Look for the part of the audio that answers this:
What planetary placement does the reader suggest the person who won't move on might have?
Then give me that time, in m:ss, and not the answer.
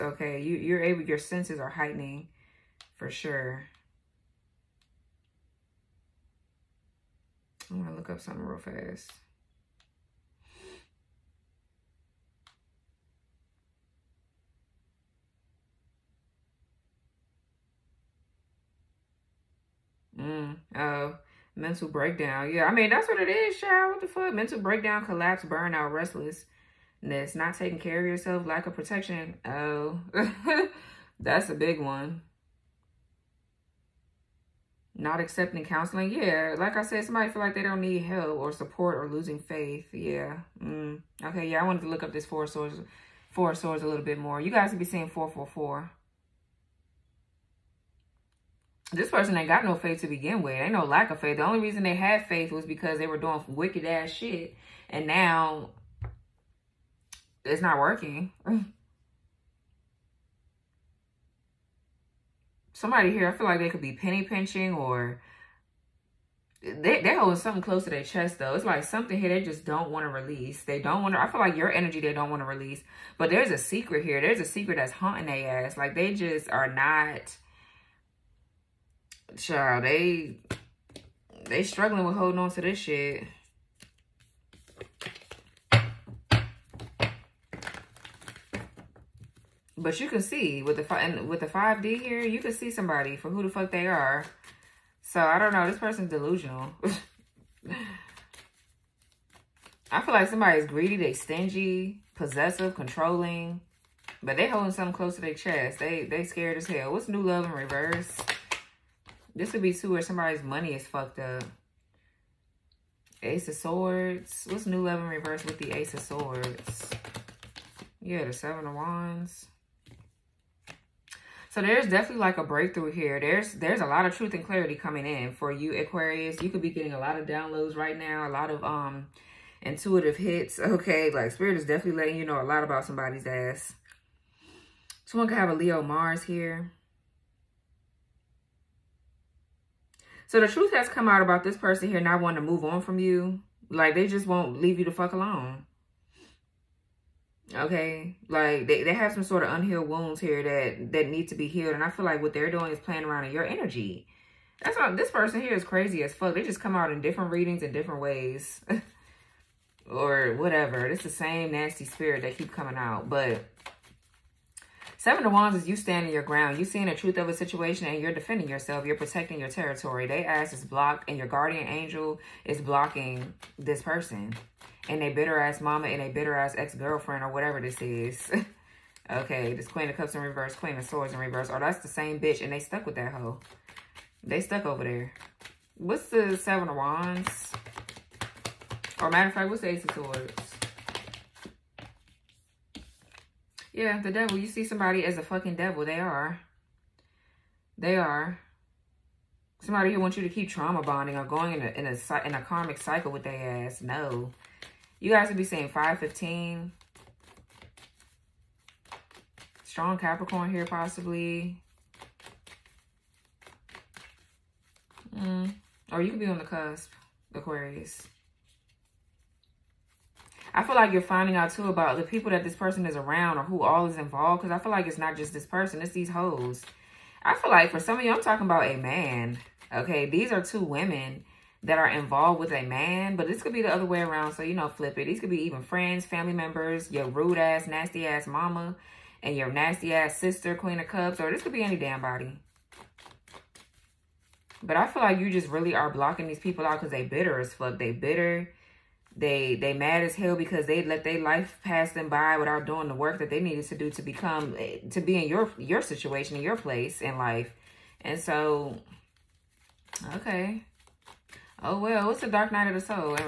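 2:15.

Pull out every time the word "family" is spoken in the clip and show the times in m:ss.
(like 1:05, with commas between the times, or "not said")
3:56.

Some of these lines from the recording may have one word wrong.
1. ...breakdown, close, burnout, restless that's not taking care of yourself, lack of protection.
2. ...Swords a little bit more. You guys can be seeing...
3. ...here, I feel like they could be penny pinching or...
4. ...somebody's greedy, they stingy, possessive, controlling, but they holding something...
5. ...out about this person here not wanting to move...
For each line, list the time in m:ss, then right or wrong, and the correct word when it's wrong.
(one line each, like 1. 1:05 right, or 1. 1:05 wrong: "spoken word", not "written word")
1. 0:24 wrong: "collapse", not "close"
2. 0:43 right
3. 1:03 right
4. 1:40 right
5. 2:21 right.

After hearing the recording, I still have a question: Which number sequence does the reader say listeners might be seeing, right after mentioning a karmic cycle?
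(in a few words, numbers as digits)
515.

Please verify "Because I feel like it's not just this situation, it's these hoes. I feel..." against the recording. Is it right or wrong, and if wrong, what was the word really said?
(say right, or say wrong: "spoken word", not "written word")
wrong: "person", not "situation".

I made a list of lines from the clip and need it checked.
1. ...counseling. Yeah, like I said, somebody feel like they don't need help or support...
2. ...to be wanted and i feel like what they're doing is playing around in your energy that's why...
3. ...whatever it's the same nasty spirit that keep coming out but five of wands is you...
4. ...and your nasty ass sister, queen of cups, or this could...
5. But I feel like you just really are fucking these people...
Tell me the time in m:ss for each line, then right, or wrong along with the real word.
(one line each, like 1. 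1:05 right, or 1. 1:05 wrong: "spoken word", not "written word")
1. 0:35 right
2. 2:31 wrong: "healed", not "wanted"
3. 2:40 wrong: "seven", not "five"
4. 3:59 right
5. 4:04 wrong: "blocking", not "fucking".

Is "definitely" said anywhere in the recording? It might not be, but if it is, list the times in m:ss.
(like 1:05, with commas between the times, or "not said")
2:01, 2:11.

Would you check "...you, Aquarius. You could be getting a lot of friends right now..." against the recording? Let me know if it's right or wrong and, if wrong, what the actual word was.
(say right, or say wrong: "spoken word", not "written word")
wrong: "downloads", not "friends".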